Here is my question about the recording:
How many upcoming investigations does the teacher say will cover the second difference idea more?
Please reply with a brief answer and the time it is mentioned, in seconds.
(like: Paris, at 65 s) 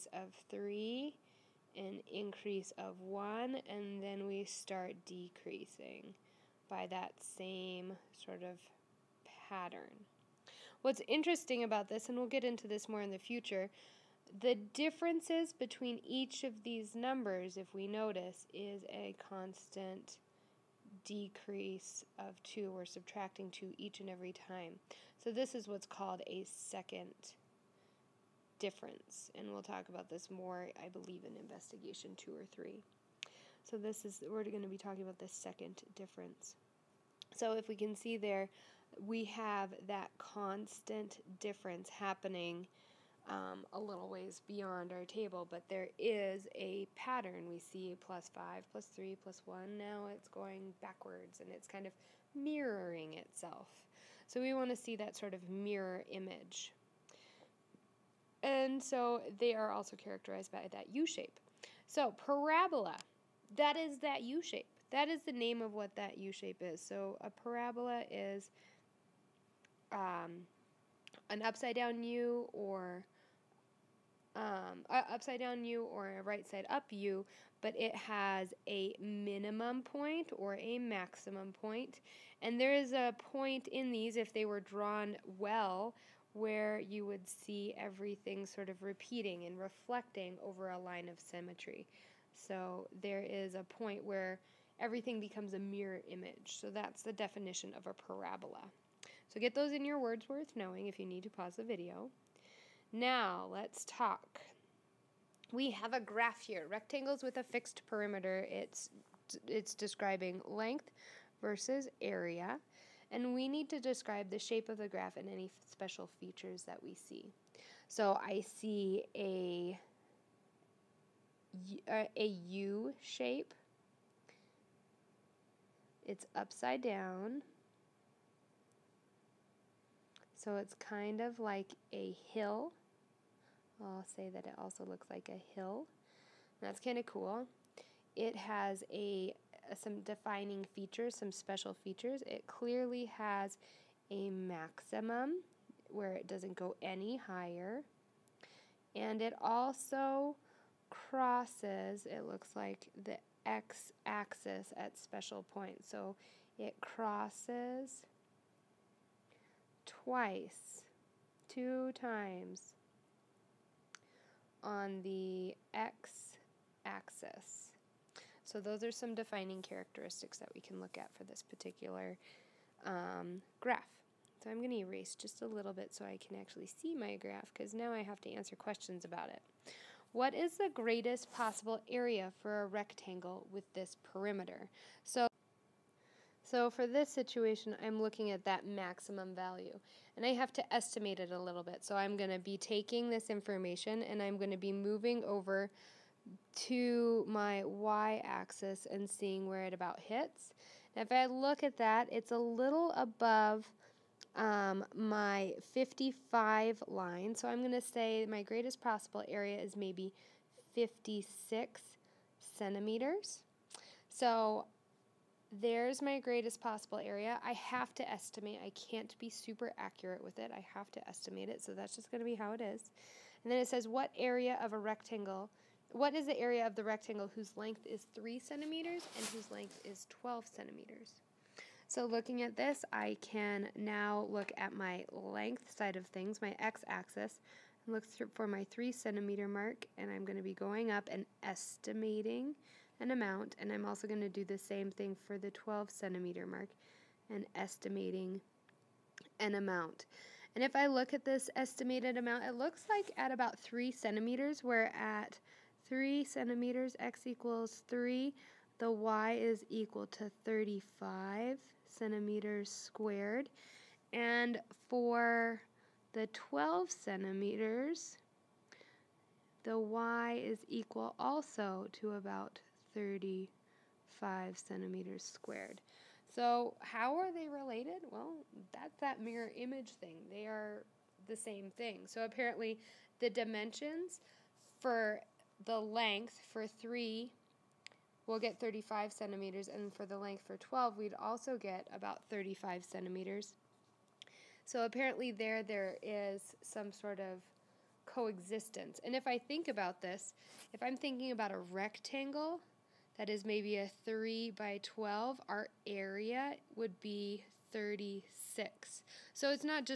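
two or three, at 31 s.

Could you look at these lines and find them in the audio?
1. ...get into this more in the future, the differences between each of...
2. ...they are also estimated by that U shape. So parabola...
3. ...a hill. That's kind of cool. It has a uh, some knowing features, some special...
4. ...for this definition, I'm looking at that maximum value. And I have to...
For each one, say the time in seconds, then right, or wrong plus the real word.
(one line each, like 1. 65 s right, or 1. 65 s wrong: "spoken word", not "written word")
1. 12 s right
2. 59 s wrong: "characterized", not "estimated"
3. 135 s wrong: "defining", not "knowing"
4. 186 s wrong: "situation", not "definition".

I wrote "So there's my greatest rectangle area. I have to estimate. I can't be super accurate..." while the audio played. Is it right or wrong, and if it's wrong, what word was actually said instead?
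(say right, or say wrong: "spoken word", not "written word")
wrong: "possible", not "rectangle".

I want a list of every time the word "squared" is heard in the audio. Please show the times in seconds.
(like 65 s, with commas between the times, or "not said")
262 s, 275 s.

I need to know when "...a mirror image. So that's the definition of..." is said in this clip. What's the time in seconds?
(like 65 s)
95 s.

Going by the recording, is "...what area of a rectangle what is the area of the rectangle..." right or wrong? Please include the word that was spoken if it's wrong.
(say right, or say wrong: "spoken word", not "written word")
right.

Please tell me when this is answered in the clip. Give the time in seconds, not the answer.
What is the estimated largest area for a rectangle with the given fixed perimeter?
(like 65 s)
209 s.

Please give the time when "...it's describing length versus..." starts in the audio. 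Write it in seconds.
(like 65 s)
109 s.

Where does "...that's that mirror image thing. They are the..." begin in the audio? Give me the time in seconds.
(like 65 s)
278 s.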